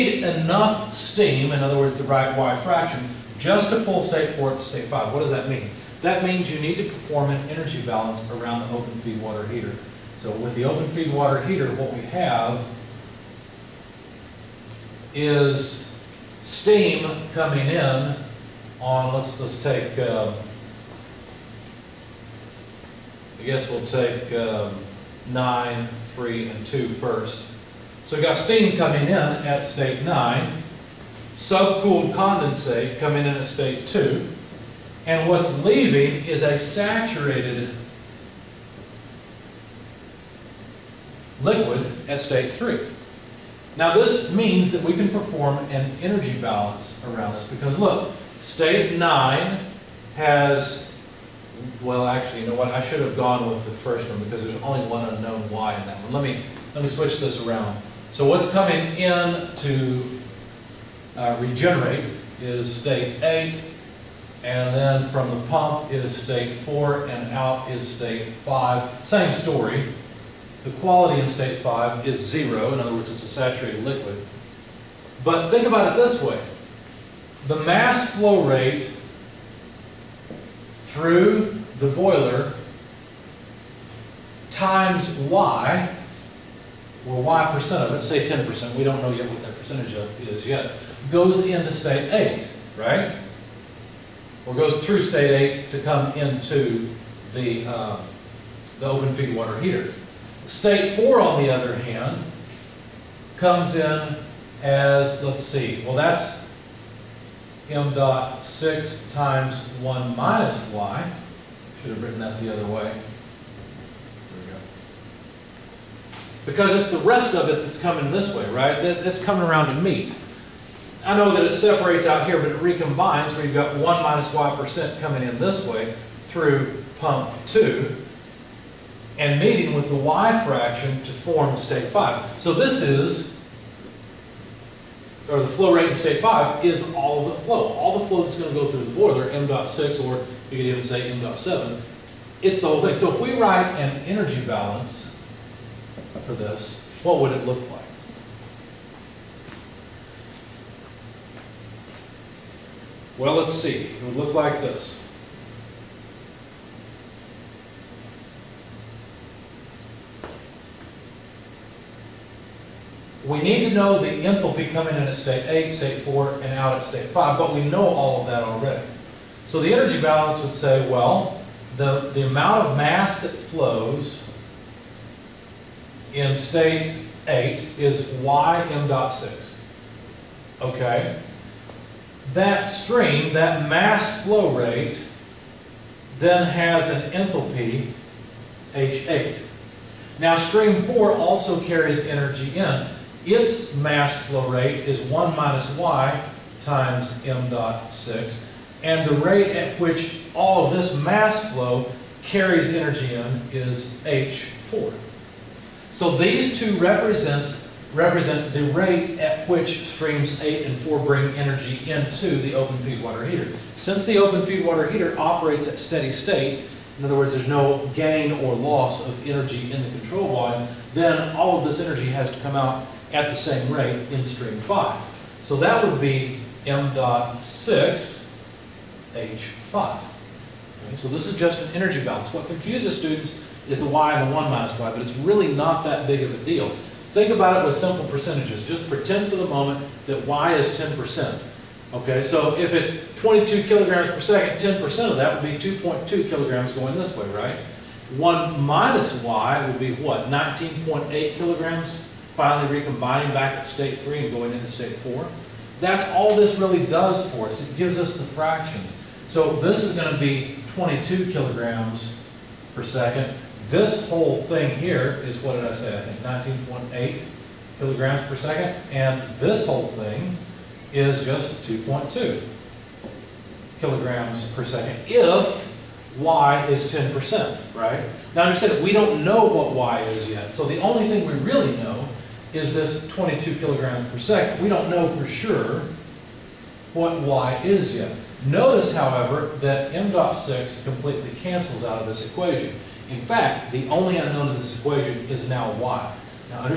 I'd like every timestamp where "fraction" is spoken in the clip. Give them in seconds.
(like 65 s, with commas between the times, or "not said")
2 s, 130 s, 258 s.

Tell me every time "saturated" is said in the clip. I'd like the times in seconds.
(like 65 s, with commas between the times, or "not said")
36 s, 73 s.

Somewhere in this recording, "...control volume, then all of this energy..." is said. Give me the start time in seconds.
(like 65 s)
219 s.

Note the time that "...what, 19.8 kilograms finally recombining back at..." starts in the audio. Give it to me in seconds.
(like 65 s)
249 s.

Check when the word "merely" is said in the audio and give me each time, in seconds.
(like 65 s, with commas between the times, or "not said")
not said.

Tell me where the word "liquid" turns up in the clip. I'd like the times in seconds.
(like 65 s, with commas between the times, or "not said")
41 s, 73 s.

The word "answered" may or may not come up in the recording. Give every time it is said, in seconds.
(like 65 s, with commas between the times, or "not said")
not said.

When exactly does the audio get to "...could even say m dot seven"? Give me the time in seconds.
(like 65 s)
140 s.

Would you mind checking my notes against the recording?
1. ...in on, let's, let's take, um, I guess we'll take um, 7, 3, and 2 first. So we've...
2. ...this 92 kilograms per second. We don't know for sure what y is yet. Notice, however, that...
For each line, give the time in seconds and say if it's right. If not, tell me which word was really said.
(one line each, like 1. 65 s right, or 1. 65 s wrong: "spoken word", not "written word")
1. 17 s wrong: "9", not "7"
2. 282 s wrong: "22", not "92".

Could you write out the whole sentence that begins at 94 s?
Or goes through state 8 to come into the, um, the open feed water heater.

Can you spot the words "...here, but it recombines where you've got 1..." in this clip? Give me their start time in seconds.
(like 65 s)
122 s.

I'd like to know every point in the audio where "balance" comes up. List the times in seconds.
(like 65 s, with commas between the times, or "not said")
7 s, 46 s, 144 s, 170 s, 232 s.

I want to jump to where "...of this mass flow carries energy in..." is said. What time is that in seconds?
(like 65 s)
200 s.